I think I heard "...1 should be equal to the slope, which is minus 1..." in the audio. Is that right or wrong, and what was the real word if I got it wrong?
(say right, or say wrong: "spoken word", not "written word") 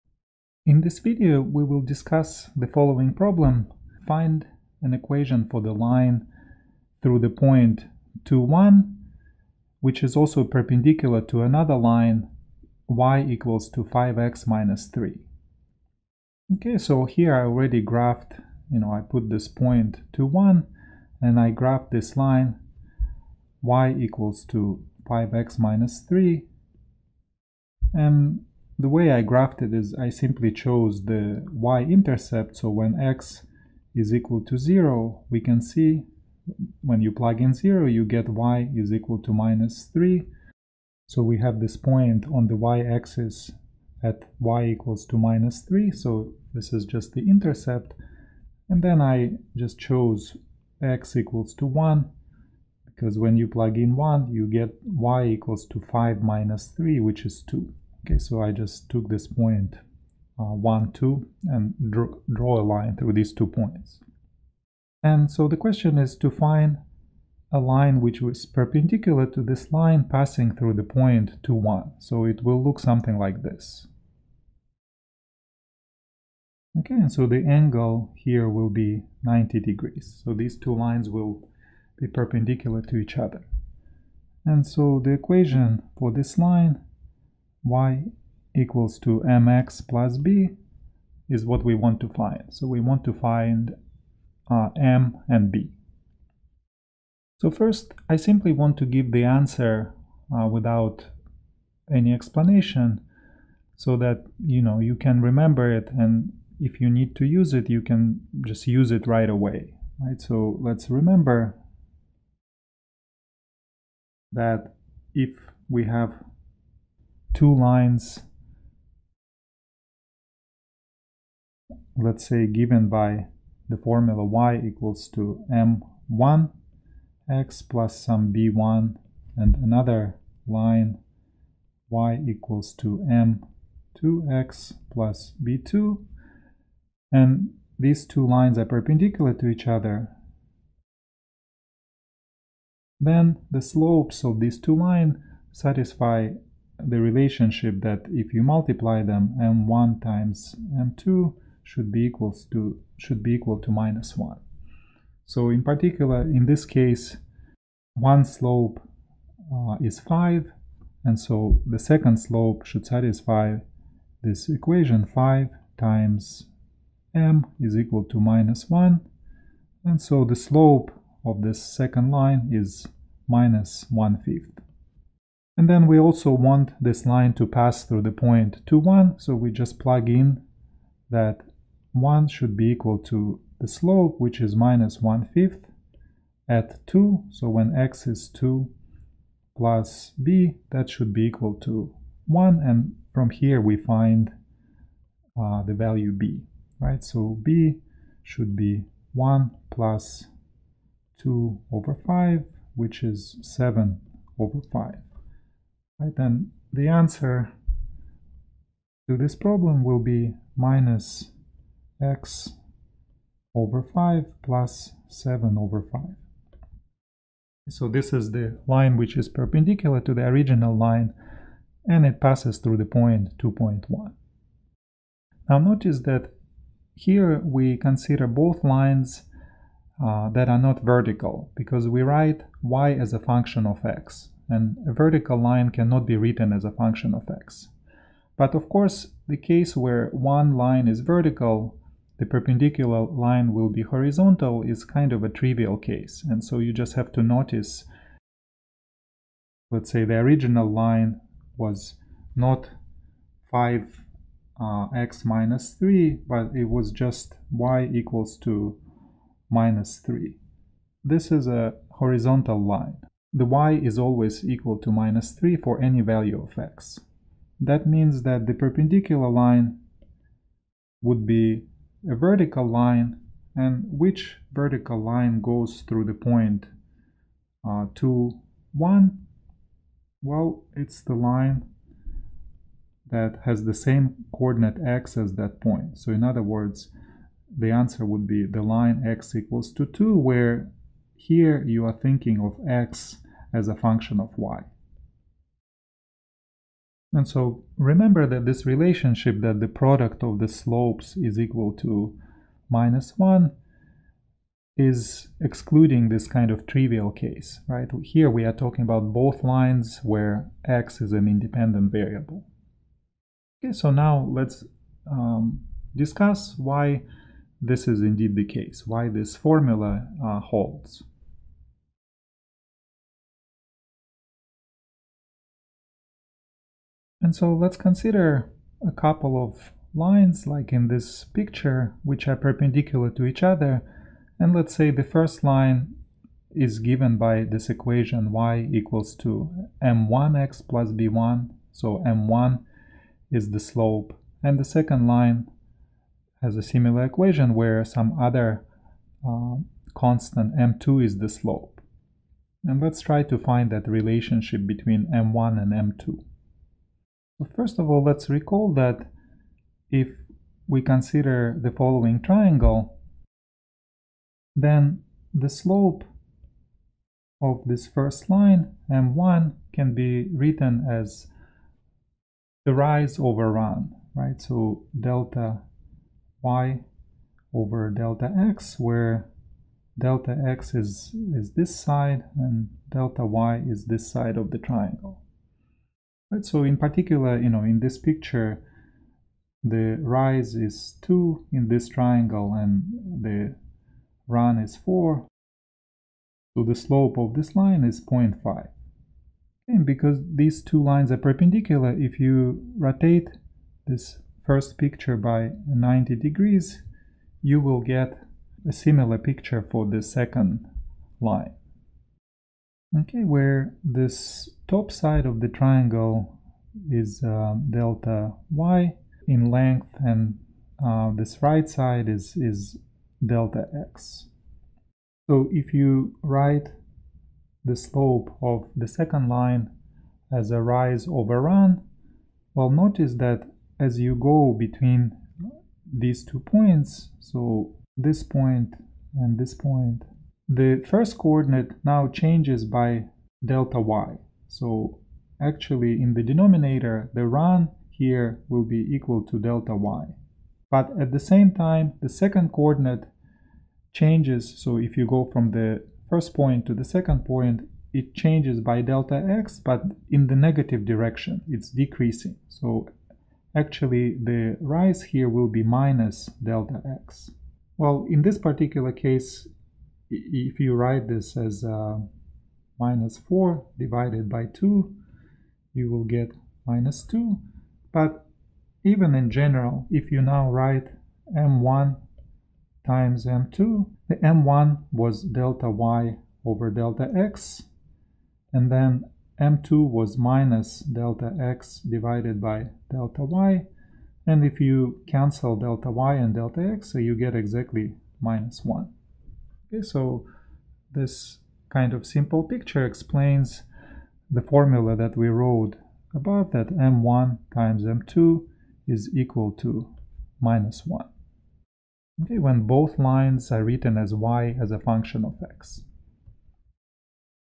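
right.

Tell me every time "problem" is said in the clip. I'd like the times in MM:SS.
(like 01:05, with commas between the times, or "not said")
00:03, 03:29.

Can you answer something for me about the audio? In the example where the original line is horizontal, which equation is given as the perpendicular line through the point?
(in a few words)
x = 2.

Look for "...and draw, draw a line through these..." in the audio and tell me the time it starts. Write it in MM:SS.
01:01.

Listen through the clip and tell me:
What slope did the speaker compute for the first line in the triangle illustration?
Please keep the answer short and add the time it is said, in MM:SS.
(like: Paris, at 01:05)
0.5, at 06:38.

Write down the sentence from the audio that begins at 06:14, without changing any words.
So delta y over delta x, where delta x is, is this side and delta y is this side of the triangle.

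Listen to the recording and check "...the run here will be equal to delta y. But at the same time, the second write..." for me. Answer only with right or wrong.
wrong.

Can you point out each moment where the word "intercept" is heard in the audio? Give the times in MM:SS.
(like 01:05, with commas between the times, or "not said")
00:31, 00:47.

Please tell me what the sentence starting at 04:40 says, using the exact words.
Well, it's the line that has the same coordinate x as that point.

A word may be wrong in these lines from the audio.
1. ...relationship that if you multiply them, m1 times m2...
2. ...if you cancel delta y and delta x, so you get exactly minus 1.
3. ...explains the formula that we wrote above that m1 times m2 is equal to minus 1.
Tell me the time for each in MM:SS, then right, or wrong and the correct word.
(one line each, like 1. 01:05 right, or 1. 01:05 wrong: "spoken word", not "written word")
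1. 02:26 right
2. 08:14 right
3. 08:22 right.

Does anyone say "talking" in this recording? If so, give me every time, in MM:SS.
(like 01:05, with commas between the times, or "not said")
05:08.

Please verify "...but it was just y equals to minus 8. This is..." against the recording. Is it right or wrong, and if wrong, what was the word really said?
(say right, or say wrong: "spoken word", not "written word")
wrong: "3", not "8".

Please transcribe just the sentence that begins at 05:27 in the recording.
And so let's consider a couple of lines like in this picture, which are perpendicular to each other.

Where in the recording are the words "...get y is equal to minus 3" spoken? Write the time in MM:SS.
00:38.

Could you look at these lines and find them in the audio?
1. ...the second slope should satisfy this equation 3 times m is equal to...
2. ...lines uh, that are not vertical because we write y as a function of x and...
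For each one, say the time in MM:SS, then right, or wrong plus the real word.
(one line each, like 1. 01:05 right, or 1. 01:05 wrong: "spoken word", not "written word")
1. 02:41 wrong: "5", not "3"
2. 03:48 right.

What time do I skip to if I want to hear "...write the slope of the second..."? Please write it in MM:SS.
07:06.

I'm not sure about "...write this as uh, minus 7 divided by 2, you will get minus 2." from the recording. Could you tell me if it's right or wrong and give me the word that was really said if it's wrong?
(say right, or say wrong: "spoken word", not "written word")
wrong: "4", not "7".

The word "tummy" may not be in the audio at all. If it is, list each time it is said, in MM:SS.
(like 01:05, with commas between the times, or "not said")
not said.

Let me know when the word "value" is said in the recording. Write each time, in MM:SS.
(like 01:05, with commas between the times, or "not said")
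03:15, 04:26.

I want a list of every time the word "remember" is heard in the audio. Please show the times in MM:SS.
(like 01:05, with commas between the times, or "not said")
01:45, 01:50, 04:57.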